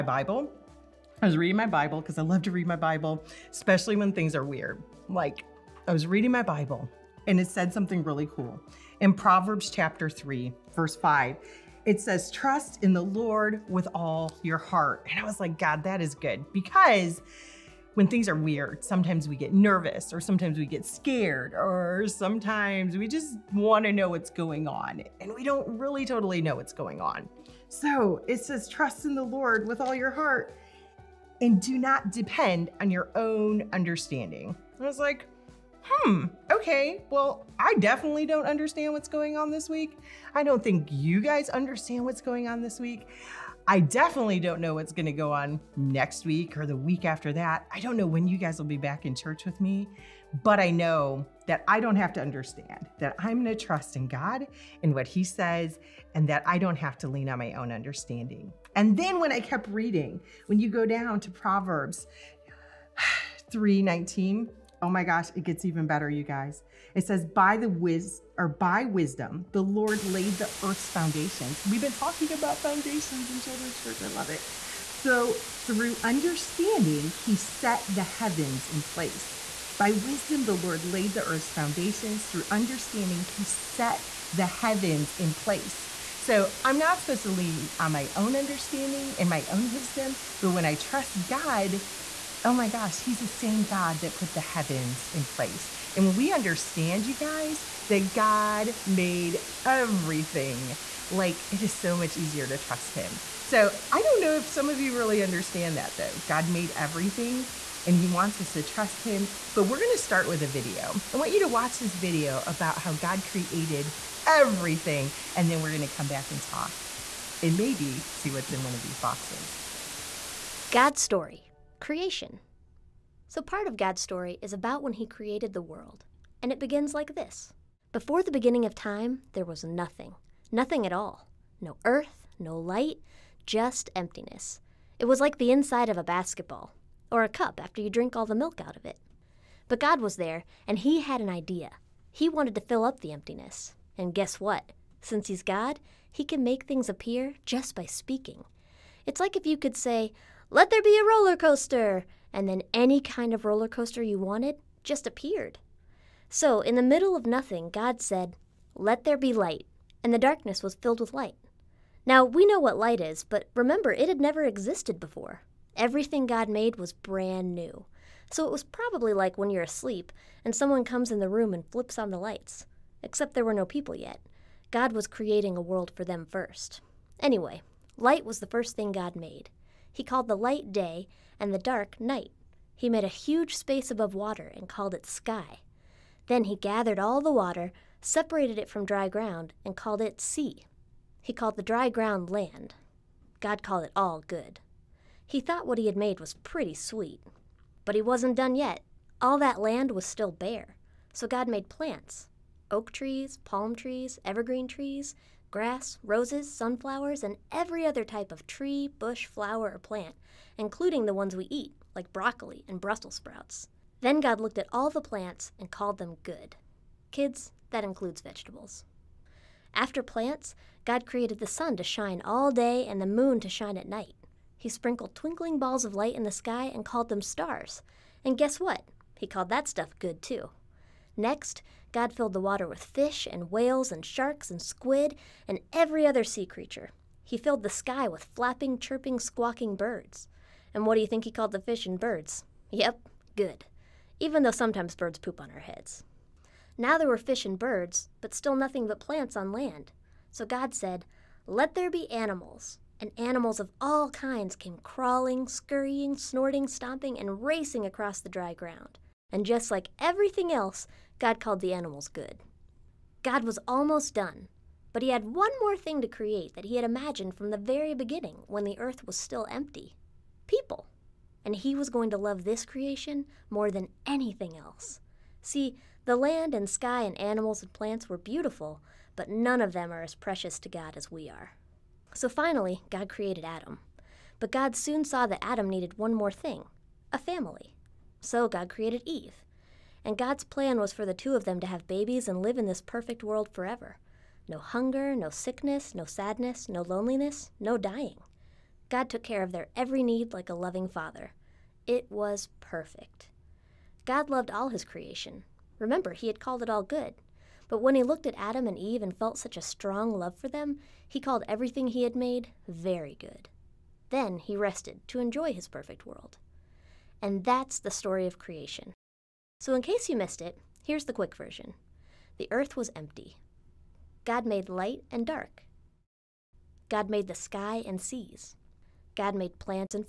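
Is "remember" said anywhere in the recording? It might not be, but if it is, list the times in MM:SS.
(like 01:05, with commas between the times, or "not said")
02:43, 05:05.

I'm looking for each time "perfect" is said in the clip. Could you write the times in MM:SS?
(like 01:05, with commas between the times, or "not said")
04:52, 05:02, 05:15.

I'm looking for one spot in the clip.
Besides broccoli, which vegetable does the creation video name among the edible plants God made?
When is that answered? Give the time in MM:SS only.
03:32.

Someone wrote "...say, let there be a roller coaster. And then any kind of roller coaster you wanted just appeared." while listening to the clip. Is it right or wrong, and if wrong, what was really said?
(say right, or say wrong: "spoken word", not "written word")
right.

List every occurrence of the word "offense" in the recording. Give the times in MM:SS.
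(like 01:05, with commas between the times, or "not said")
not said.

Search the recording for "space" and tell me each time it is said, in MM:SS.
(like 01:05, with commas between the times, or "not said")
03:03.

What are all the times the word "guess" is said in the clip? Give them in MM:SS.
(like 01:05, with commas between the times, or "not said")
02:24, 03:48.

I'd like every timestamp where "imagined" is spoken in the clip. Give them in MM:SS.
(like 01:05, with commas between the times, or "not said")
04:26.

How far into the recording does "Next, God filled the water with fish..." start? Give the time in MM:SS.
03:51.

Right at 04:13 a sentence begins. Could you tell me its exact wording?
And animals of all kinds came crawling, scurrying, snorting, stomping, and racing across the dry ground.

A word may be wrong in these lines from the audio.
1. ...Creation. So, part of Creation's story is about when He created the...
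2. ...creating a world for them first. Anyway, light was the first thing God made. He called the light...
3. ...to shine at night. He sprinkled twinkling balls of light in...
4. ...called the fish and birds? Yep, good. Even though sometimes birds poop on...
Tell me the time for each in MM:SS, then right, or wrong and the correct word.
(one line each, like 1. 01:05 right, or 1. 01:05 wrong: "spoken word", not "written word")
1. 02:01 wrong: "God", not "Creation"
2. 02:55 right
3. 03:43 right
4. 04:01 right.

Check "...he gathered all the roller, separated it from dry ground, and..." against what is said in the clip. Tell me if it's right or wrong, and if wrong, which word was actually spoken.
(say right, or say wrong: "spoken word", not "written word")
wrong: "water", not "roller".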